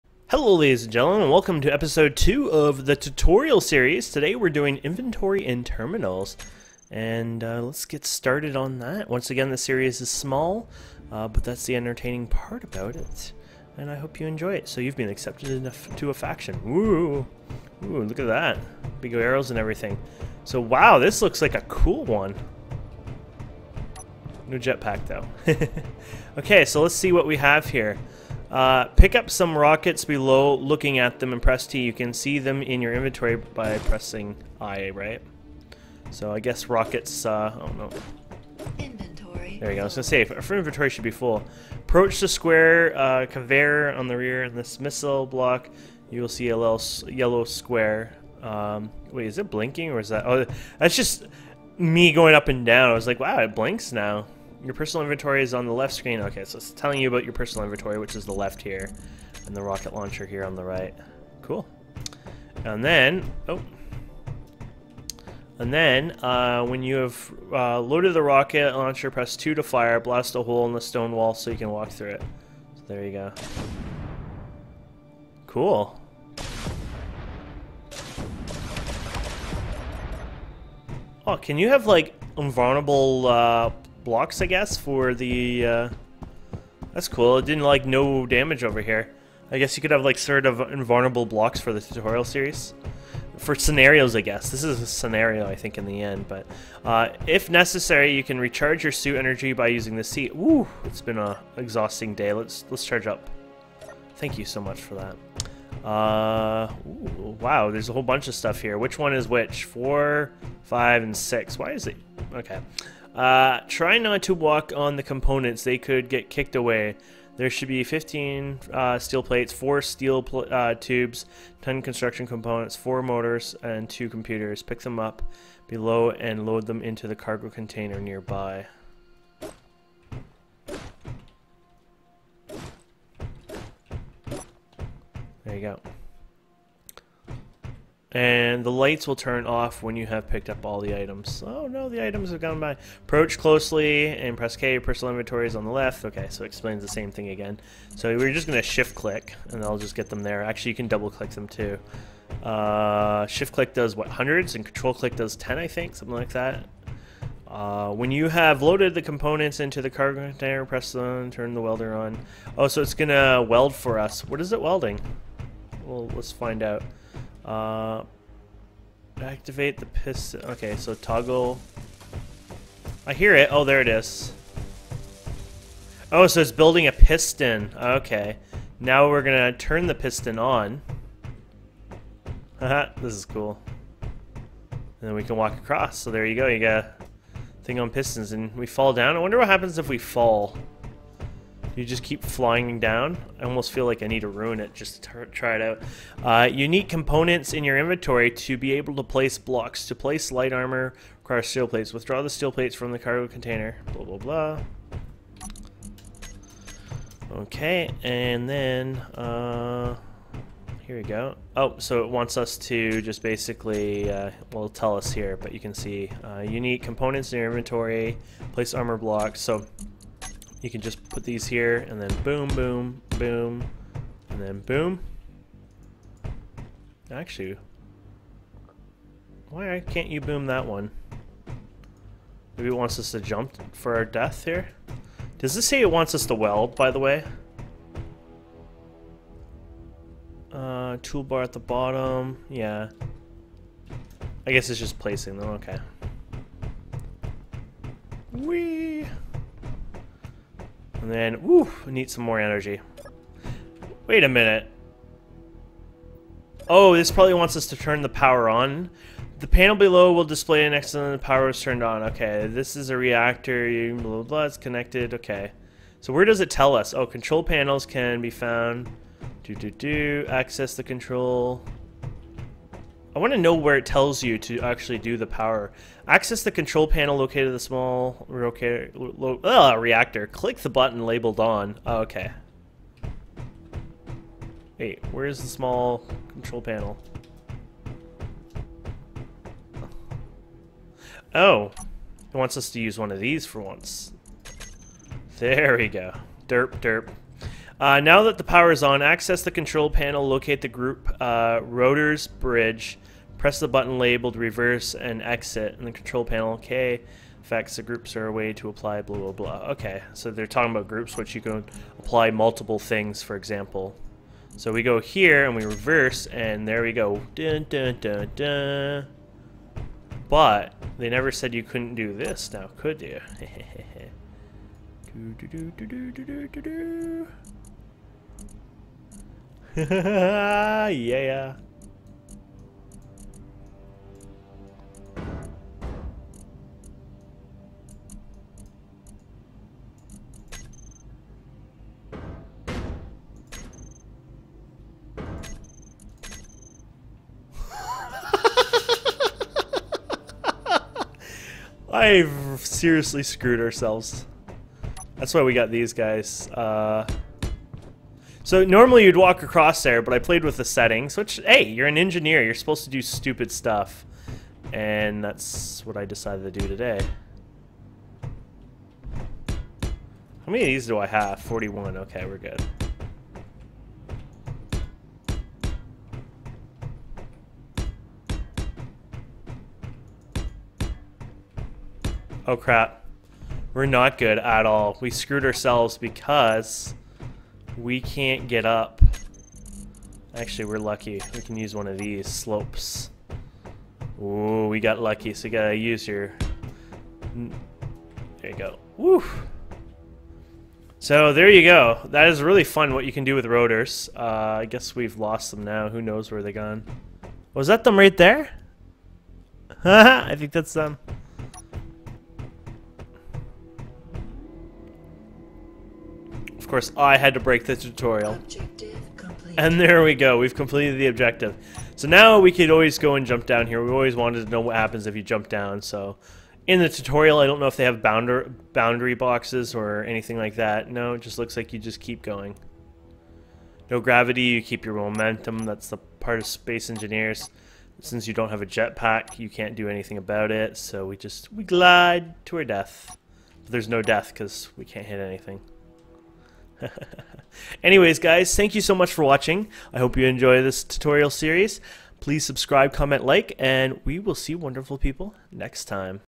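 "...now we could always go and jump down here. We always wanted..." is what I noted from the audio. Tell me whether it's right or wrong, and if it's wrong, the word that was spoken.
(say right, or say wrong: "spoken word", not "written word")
right.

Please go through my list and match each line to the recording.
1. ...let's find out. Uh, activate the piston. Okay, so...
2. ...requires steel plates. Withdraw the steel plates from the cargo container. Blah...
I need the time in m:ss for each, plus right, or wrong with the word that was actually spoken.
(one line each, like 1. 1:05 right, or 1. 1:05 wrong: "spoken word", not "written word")
1. 2:46 right
2. 3:21 right.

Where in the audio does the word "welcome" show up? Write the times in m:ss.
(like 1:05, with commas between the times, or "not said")
0:01.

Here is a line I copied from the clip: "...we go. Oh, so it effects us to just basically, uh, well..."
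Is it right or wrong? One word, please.
wrong.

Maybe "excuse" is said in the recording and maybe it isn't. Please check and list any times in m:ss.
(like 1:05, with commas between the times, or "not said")
not said.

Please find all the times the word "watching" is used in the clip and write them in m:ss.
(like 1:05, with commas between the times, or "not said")
7:29.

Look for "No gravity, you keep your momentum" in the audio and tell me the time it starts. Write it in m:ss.
7:13.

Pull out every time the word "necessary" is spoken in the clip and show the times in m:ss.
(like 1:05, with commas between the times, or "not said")
1:37.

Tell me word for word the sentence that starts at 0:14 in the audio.
So you've been accepted into a faction.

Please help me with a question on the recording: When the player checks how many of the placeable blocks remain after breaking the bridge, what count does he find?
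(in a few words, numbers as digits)
41.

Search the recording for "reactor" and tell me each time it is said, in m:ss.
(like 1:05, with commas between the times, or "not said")
4:22, 4:39.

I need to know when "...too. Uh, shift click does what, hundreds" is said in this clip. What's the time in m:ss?
2:31.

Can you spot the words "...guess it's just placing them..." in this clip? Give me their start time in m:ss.
4:04.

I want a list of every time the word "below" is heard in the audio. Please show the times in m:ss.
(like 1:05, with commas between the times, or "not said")
0:30, 2:05, 4:19.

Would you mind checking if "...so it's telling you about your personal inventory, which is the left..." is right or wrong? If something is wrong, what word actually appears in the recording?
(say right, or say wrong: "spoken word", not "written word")
right.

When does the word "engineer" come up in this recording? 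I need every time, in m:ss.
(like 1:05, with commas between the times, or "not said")
6:01, 7:16.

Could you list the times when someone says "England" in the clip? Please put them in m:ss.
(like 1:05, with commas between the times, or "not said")
not said.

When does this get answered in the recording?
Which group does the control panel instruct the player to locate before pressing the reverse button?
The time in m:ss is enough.
5:01.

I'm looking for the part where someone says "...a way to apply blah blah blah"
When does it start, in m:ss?
5:08.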